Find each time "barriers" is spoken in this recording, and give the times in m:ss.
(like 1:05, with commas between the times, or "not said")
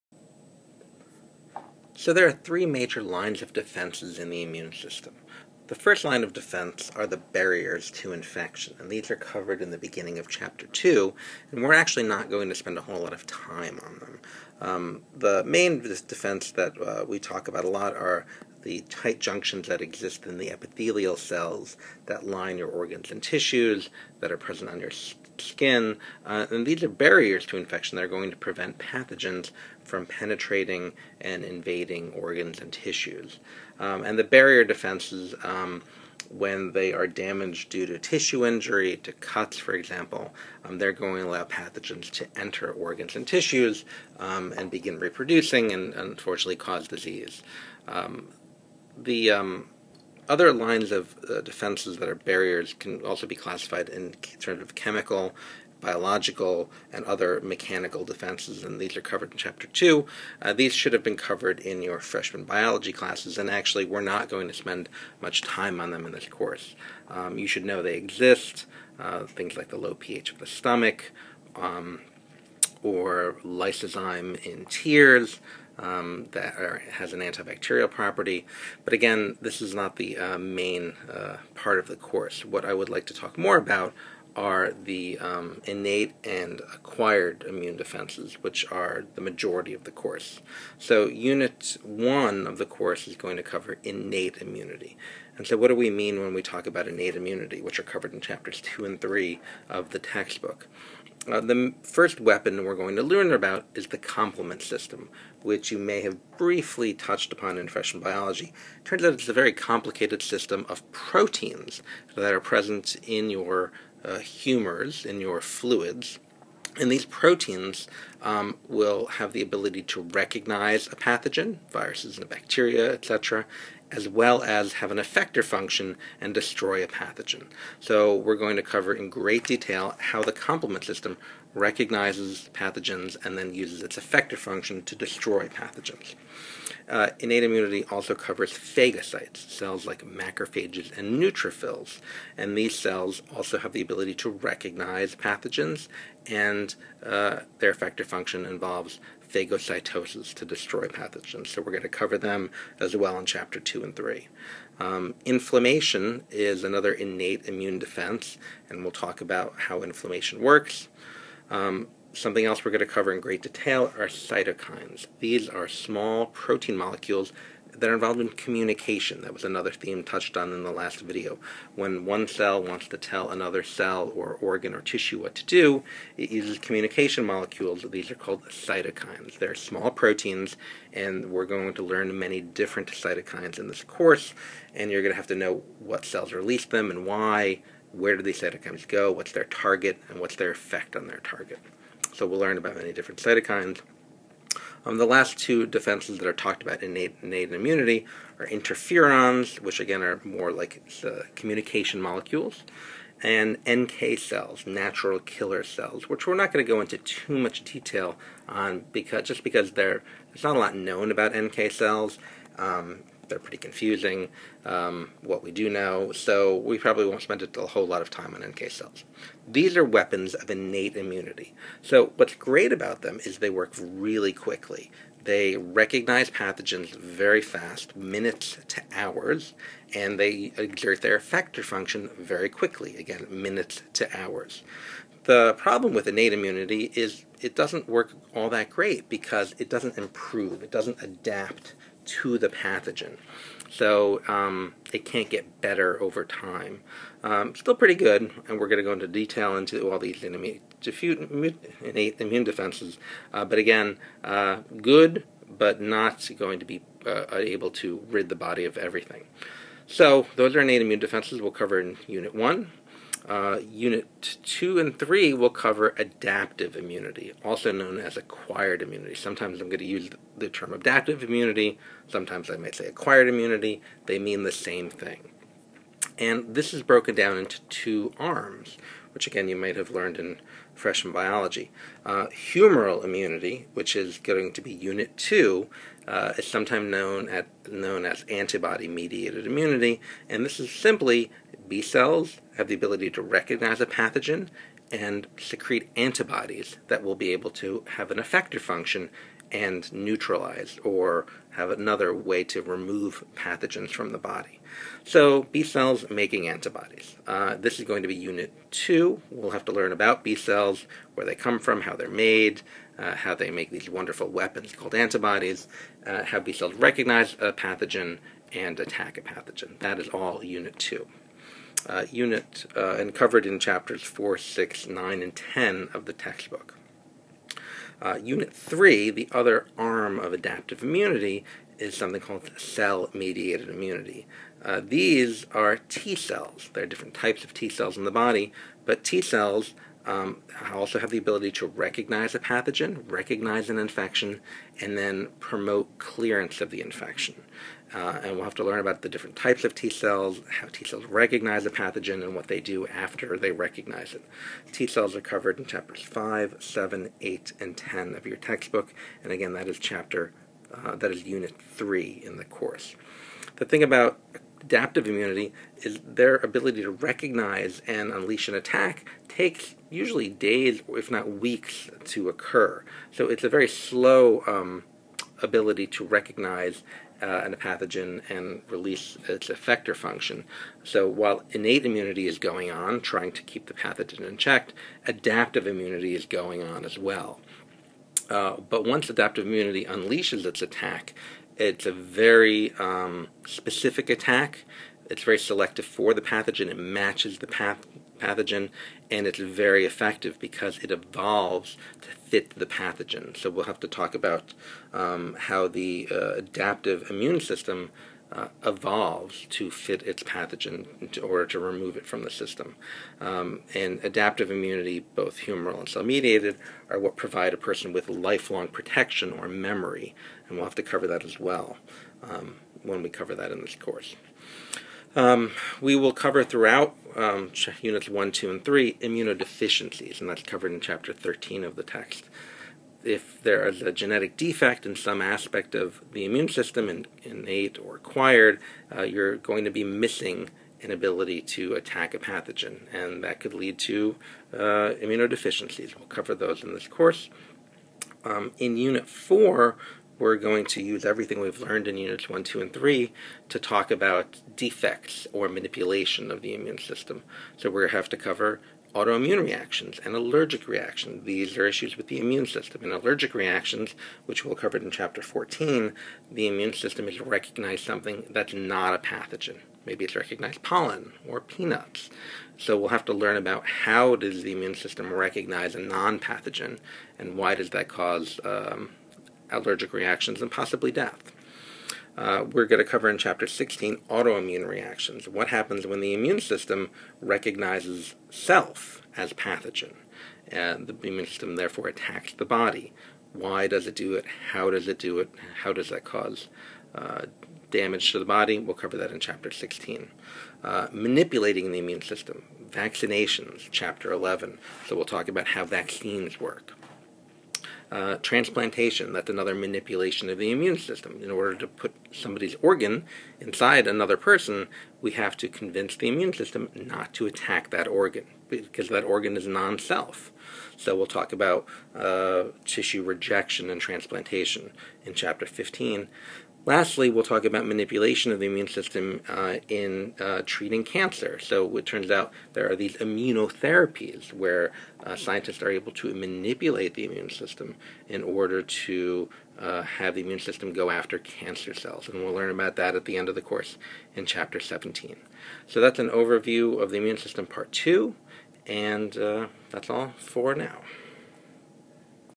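0:07, 0:26, 0:34, 0:52.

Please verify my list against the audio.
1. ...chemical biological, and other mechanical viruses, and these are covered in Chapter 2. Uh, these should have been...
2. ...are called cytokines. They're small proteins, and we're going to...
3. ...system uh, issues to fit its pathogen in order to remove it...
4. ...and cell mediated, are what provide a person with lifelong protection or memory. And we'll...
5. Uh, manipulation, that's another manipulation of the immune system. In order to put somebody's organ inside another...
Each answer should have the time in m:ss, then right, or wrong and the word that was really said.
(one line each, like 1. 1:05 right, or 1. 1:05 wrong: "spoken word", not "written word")
1. 0:54 wrong: "defenses", not "viruses"
2. 2:58 right
3. 6:47 wrong: "evolves", not "issues"
4. 6:55 right
5. 8:27 wrong: "transplantation", not "manipulation".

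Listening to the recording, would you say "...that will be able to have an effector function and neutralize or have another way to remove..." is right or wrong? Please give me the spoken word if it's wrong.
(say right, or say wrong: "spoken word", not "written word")
right.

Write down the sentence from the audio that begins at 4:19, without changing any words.
So those are innate immune defenses we'll cover in Unit 1.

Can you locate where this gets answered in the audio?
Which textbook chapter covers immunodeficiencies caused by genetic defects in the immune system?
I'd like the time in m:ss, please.
7:10.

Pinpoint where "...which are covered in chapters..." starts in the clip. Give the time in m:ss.
1:37.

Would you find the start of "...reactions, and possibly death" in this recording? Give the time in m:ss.
7:59.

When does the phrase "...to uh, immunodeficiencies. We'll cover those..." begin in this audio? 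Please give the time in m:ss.
7:23.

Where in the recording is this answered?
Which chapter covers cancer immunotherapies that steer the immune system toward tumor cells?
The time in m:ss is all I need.
9:04.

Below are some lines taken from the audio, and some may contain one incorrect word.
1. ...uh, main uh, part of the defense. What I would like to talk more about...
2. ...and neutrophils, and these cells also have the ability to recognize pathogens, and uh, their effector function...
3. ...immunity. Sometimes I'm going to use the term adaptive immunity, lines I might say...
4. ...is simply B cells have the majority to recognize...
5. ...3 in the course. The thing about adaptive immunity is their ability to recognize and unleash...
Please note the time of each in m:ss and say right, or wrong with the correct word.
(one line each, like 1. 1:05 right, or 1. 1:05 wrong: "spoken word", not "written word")
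1. 1:20 wrong: "course", not "defense"
2. 2:20 right
3. 4:28 wrong: "sometimes", not "lines"
4. 4:50 wrong: "ability", not "majority"
5. 6:01 right.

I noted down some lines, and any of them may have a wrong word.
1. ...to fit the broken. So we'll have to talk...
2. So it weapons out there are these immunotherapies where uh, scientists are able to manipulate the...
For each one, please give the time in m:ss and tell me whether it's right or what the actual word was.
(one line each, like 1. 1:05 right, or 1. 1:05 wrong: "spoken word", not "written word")
1. 6:42 wrong: "pathogen", not "broken"
2. 8:51 wrong: "turns", not "weapons".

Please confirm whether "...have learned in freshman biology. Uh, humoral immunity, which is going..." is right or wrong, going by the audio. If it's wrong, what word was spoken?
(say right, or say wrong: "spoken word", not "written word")
right.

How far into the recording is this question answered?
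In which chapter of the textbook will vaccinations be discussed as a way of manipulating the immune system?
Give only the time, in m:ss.
8:23.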